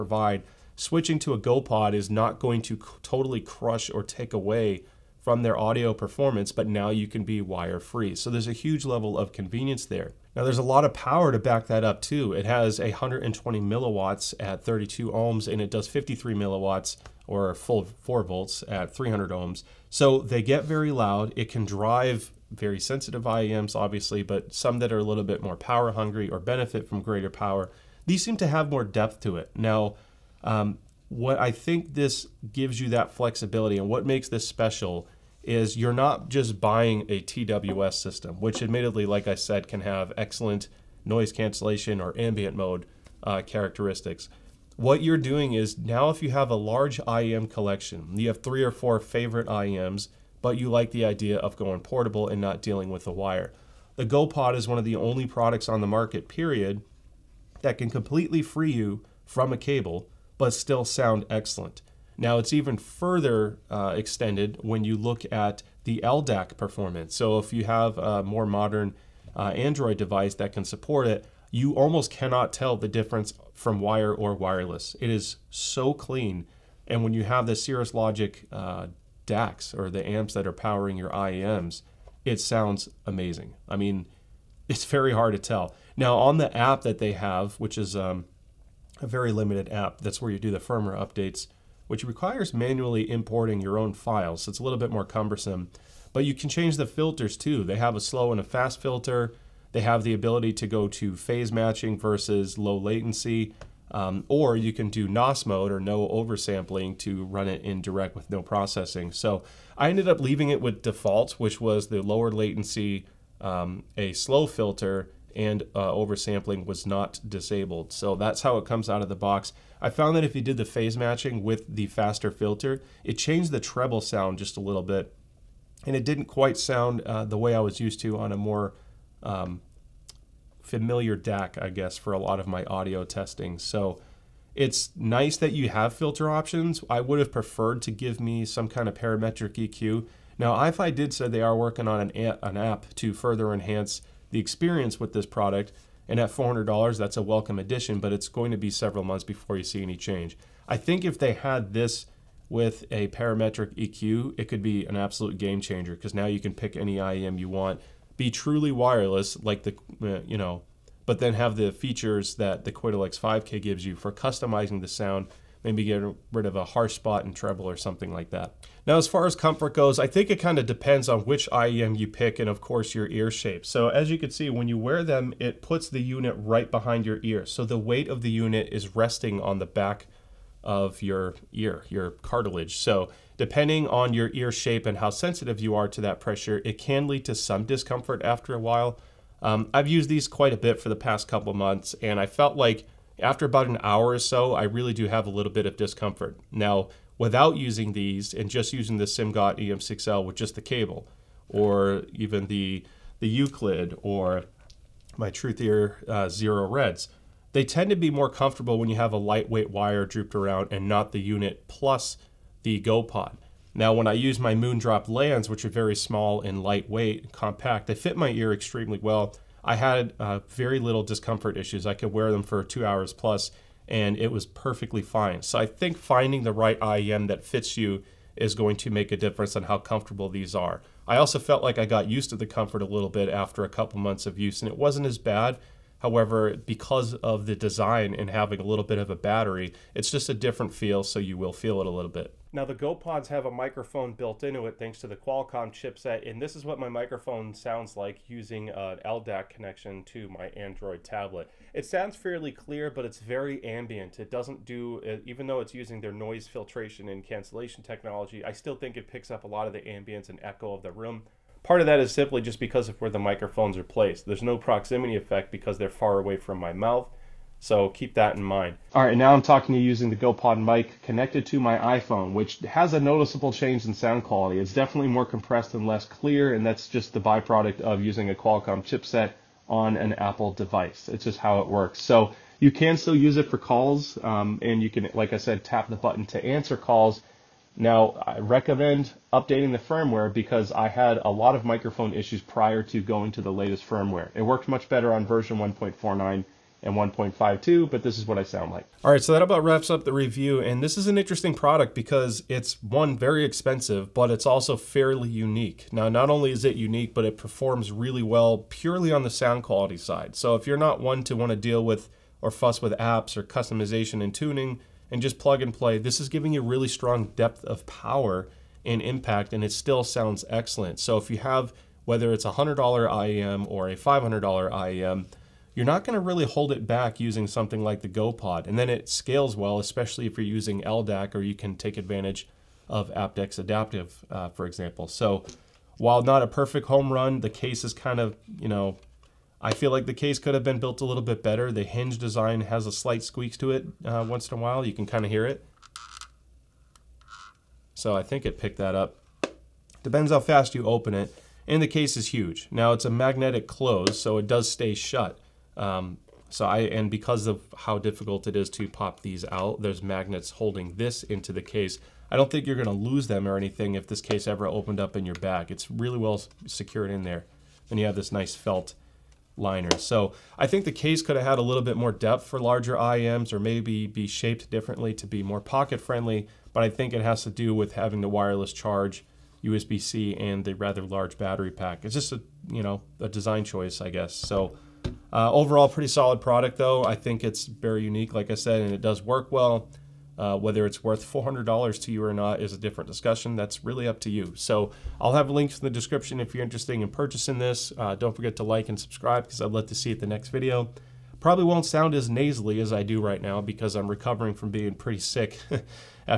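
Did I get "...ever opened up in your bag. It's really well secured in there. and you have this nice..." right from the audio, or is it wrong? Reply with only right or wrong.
right.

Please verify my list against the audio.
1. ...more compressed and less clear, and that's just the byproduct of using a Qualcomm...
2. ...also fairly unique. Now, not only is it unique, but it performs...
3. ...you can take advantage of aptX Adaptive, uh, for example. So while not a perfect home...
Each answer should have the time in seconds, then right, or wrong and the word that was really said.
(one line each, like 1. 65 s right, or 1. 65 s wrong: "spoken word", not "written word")
1. 275 s right
2. 304 s right
3. 331 s right.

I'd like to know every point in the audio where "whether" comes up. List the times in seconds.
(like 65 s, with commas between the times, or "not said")
322 s, 390 s.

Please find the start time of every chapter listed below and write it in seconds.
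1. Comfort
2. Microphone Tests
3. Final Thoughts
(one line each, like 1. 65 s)
1. 167 s
2. 241 s
3. 298 s.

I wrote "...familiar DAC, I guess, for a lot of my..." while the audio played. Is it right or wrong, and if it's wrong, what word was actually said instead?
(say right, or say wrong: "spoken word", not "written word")
right.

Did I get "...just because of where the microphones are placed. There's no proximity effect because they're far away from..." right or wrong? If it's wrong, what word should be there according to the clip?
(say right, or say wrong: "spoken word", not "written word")
right.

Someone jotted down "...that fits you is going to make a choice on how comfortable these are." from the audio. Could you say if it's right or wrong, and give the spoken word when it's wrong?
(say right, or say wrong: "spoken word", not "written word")
wrong: "difference", not "choice".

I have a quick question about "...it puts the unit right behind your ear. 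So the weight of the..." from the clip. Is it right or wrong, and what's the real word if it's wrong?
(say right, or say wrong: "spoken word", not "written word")
right.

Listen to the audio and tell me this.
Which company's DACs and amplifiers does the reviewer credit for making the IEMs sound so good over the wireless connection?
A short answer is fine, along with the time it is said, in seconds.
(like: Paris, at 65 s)
Cirrus Logic, at 77 s.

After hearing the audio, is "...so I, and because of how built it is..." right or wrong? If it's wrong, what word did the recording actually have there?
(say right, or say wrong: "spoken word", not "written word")
wrong: "difficult", not "built".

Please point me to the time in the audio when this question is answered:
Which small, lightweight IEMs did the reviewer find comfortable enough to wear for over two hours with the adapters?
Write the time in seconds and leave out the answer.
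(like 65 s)
214 s.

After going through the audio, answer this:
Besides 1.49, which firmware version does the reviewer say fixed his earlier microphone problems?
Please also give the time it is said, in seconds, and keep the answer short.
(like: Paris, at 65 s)
1.52, at 296 s.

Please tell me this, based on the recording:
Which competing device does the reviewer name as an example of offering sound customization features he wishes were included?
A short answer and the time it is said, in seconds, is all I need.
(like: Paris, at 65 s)
Qudelix 5K, at 162 s.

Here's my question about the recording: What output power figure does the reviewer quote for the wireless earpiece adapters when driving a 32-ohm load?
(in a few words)
120 milliwatts.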